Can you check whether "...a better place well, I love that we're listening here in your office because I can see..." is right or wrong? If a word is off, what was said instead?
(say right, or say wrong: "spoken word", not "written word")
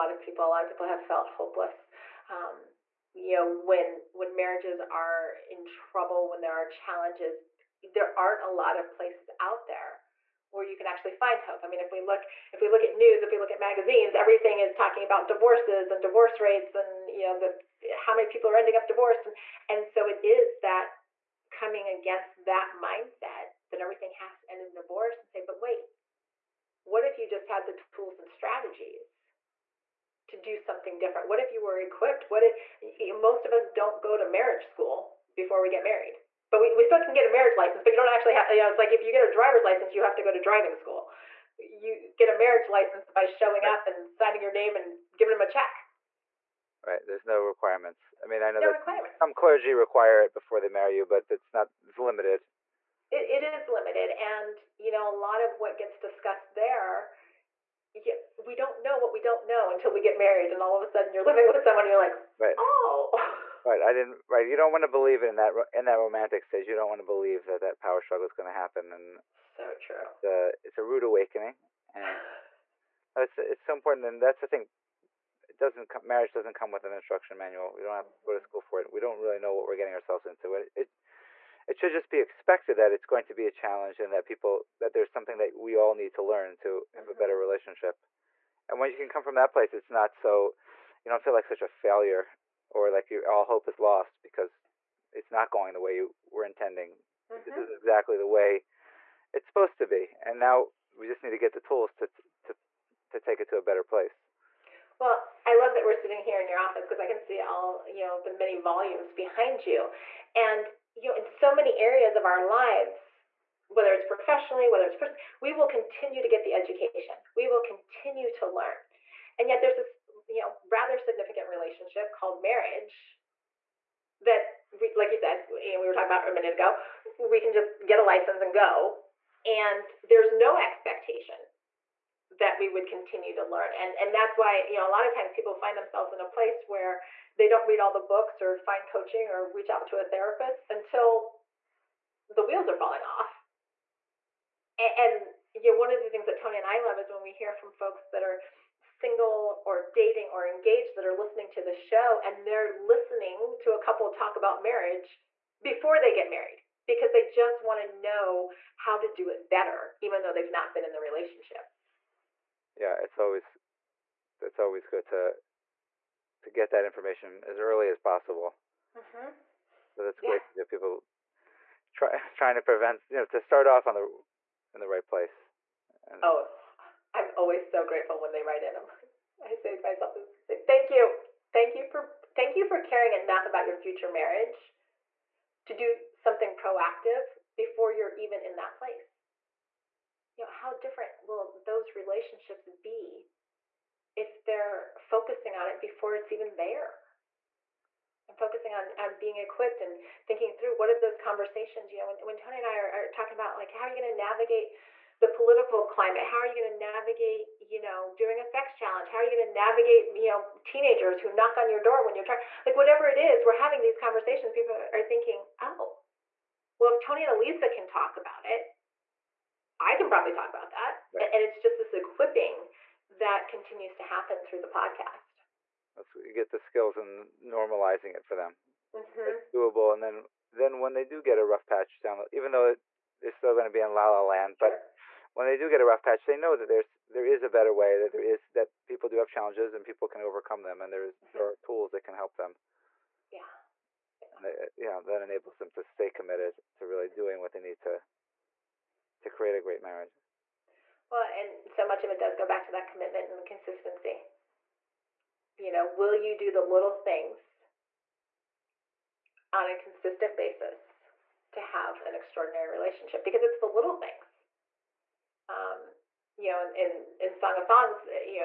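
wrong: "sitting", not "listening".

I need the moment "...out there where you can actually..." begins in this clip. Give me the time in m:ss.
0:09.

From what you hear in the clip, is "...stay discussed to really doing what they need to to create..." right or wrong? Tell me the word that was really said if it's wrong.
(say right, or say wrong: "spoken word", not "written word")
wrong: "committed", not "discussed".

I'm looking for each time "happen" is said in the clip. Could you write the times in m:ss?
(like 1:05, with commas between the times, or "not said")
1:08, 3:44.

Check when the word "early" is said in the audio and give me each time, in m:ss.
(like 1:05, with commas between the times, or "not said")
2:47.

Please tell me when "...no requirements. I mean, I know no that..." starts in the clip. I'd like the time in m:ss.
0:47.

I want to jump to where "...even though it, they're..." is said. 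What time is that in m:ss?
3:52.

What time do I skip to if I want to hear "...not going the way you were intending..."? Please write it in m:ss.
1:35.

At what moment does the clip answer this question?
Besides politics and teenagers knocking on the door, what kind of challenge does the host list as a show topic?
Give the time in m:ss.
3:28.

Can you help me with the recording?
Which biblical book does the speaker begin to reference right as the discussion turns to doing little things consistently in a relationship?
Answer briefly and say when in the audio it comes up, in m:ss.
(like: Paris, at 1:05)
Song of Songs, at 4:27.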